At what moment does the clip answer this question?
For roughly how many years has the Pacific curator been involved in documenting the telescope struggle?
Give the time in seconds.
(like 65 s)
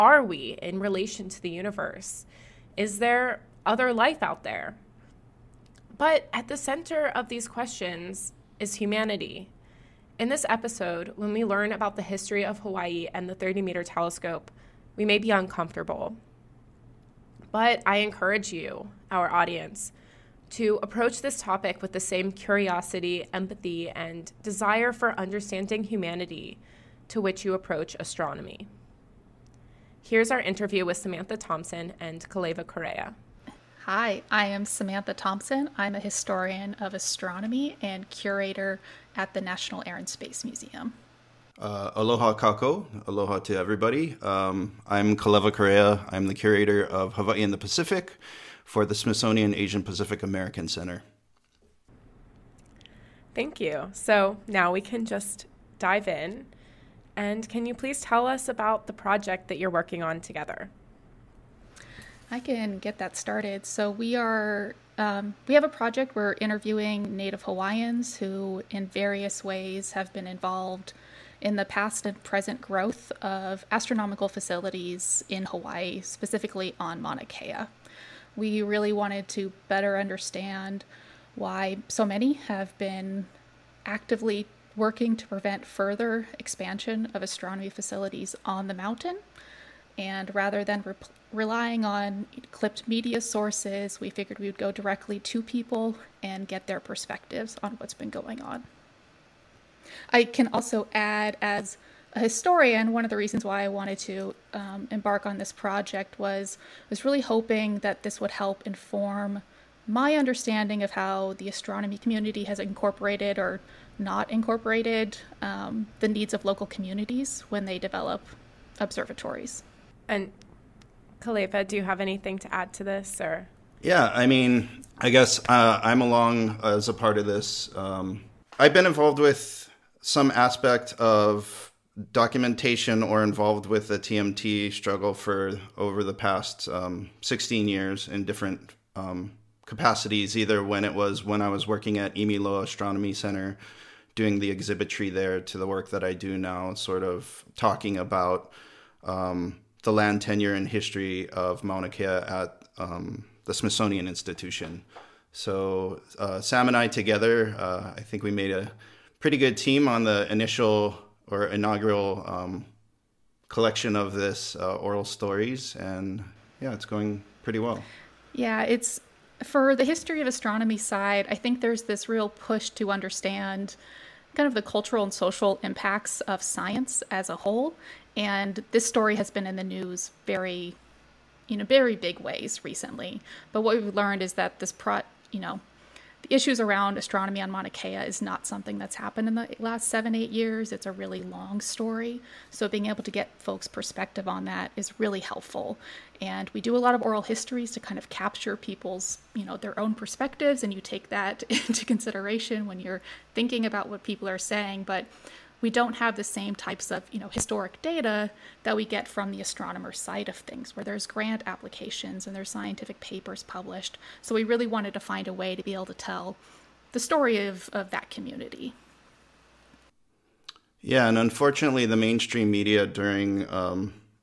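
137 s.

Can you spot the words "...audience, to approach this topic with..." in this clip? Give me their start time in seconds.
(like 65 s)
19 s.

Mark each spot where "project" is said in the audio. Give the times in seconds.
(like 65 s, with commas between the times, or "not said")
58 s, 65 s, 105 s.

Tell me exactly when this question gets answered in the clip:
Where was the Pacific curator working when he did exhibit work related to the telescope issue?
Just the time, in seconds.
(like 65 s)
142 s.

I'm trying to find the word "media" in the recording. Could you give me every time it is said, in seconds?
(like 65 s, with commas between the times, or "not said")
92 s, 222 s.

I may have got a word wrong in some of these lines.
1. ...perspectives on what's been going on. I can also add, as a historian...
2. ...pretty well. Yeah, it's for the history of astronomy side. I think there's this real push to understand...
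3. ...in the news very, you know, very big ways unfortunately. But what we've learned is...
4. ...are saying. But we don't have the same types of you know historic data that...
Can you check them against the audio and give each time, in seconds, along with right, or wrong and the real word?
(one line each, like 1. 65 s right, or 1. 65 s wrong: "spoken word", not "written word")
1. 96 s right
2. 167 s right
3. 179 s wrong: "recently", not "unfortunately"
4. 204 s right.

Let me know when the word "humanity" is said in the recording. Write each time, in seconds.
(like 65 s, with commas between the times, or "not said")
8 s, 25 s.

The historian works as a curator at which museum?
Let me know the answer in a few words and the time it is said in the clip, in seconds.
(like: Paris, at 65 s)
National Air and Space Museum, at 39 s.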